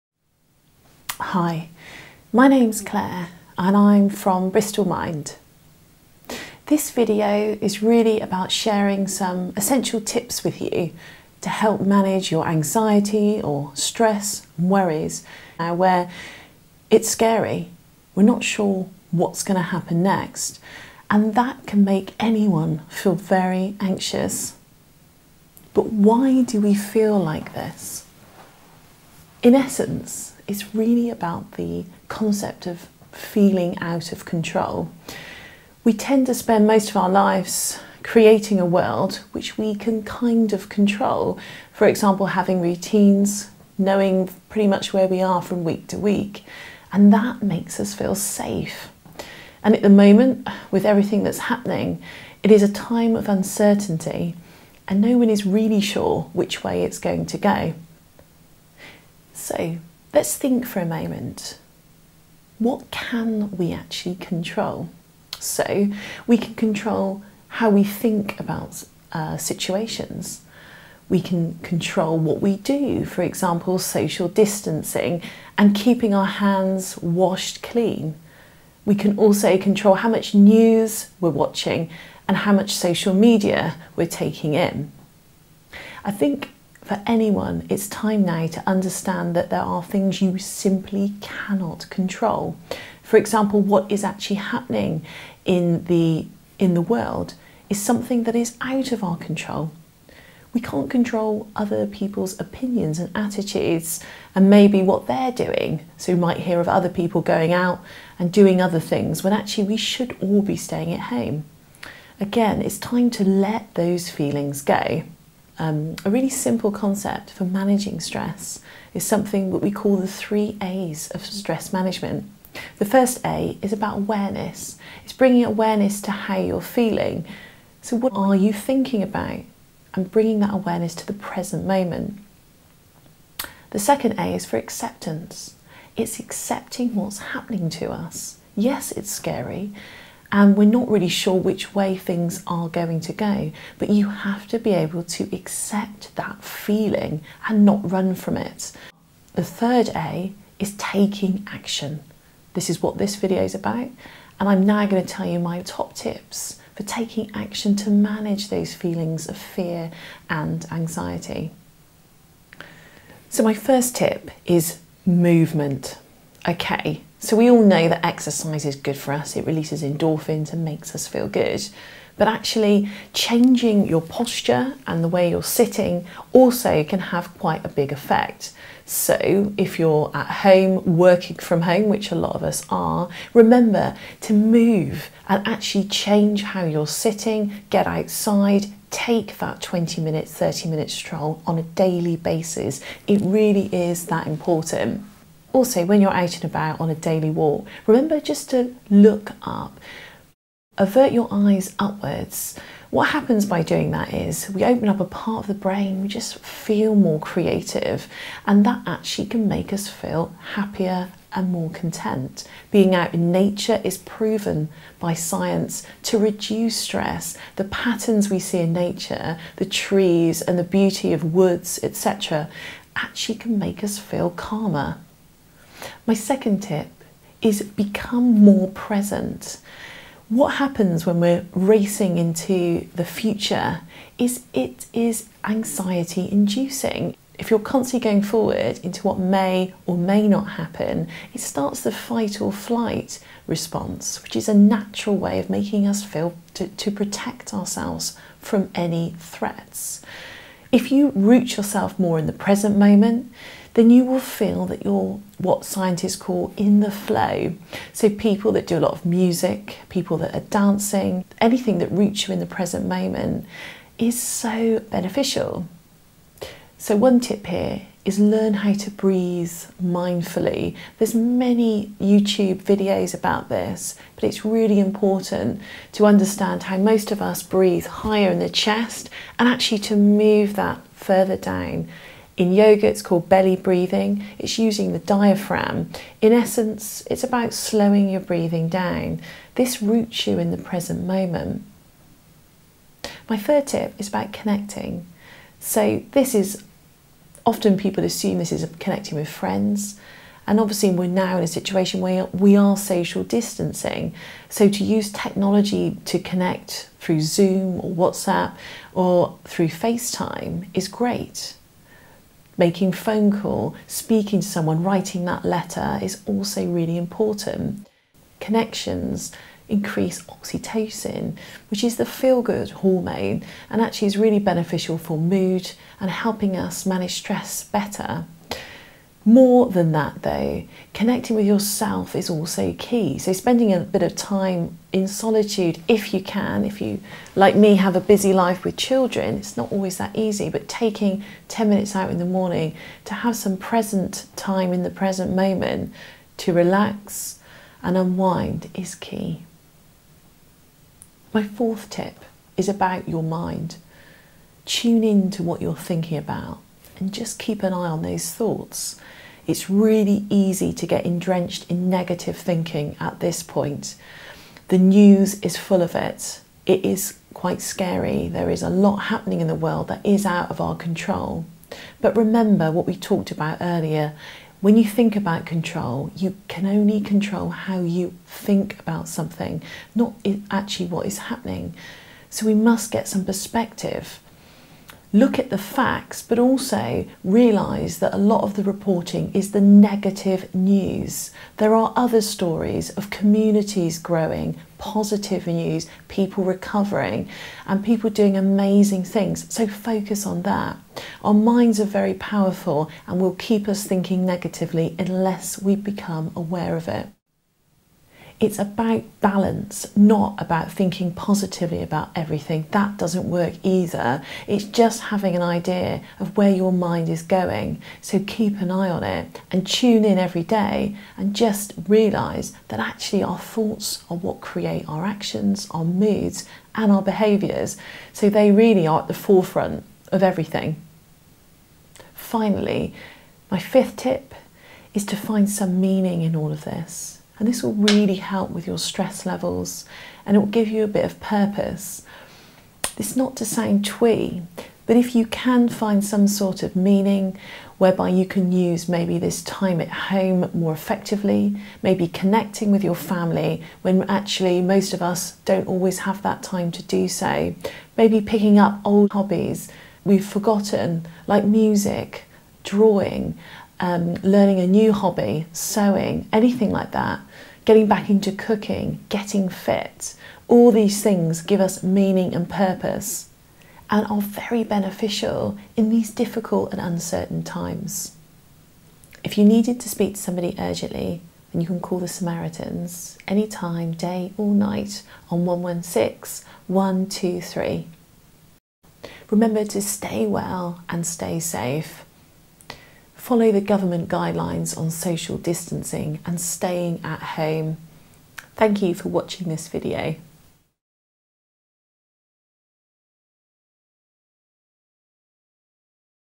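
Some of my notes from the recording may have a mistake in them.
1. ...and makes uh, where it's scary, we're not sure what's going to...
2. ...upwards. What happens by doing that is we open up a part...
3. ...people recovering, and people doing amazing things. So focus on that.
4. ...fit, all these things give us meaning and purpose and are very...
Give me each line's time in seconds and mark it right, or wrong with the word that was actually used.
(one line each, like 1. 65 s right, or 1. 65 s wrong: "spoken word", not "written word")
1. 14 s wrong: "worries", not "makes"
2. 201 s right
3. 396 s right
4. 469 s right.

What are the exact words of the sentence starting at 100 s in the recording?
We can't control other people's opinions and attitudes and maybe what they're doing.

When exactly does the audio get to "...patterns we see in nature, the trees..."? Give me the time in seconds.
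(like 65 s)
217 s.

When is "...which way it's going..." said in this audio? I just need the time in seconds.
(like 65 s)
56 s.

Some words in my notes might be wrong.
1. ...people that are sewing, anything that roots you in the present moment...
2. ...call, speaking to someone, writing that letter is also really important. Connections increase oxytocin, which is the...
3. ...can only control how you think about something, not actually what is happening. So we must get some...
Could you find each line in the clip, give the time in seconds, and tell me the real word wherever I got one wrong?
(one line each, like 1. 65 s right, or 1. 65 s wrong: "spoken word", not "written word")
1. 259 s wrong: "dancing", not "sewing"
2. 313 s right
3. 376 s right.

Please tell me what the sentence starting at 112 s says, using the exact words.
Again, it's time to let those feelings go.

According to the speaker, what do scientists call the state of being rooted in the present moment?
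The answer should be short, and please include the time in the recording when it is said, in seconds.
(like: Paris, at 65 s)
In the flow, at 256 s.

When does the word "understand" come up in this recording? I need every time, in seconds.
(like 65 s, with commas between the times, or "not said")
88 s, 276 s.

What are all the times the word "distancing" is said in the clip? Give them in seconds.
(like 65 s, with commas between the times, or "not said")
74 s, 303 s, 495 s.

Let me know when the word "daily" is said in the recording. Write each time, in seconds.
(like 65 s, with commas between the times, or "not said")
191 s, 196 s.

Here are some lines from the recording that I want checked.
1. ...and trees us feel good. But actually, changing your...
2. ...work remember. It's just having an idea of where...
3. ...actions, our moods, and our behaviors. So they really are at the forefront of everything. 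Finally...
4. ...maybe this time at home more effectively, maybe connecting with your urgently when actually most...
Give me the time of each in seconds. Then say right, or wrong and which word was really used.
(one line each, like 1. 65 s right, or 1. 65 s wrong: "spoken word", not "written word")
1. 170 s wrong: "makes", not "trees"
2. 413 s wrong: "either", not "remember"
3. 425 s right
4. 448 s wrong: "family", not "urgently".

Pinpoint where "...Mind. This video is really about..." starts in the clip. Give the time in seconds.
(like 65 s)
4 s.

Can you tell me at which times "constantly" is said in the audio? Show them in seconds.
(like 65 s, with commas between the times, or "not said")
237 s.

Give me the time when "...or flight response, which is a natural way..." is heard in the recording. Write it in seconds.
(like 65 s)
242 s.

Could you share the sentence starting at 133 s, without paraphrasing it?
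The second A is for acceptance.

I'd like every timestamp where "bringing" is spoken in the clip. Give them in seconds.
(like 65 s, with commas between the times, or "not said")
125 s, 130 s.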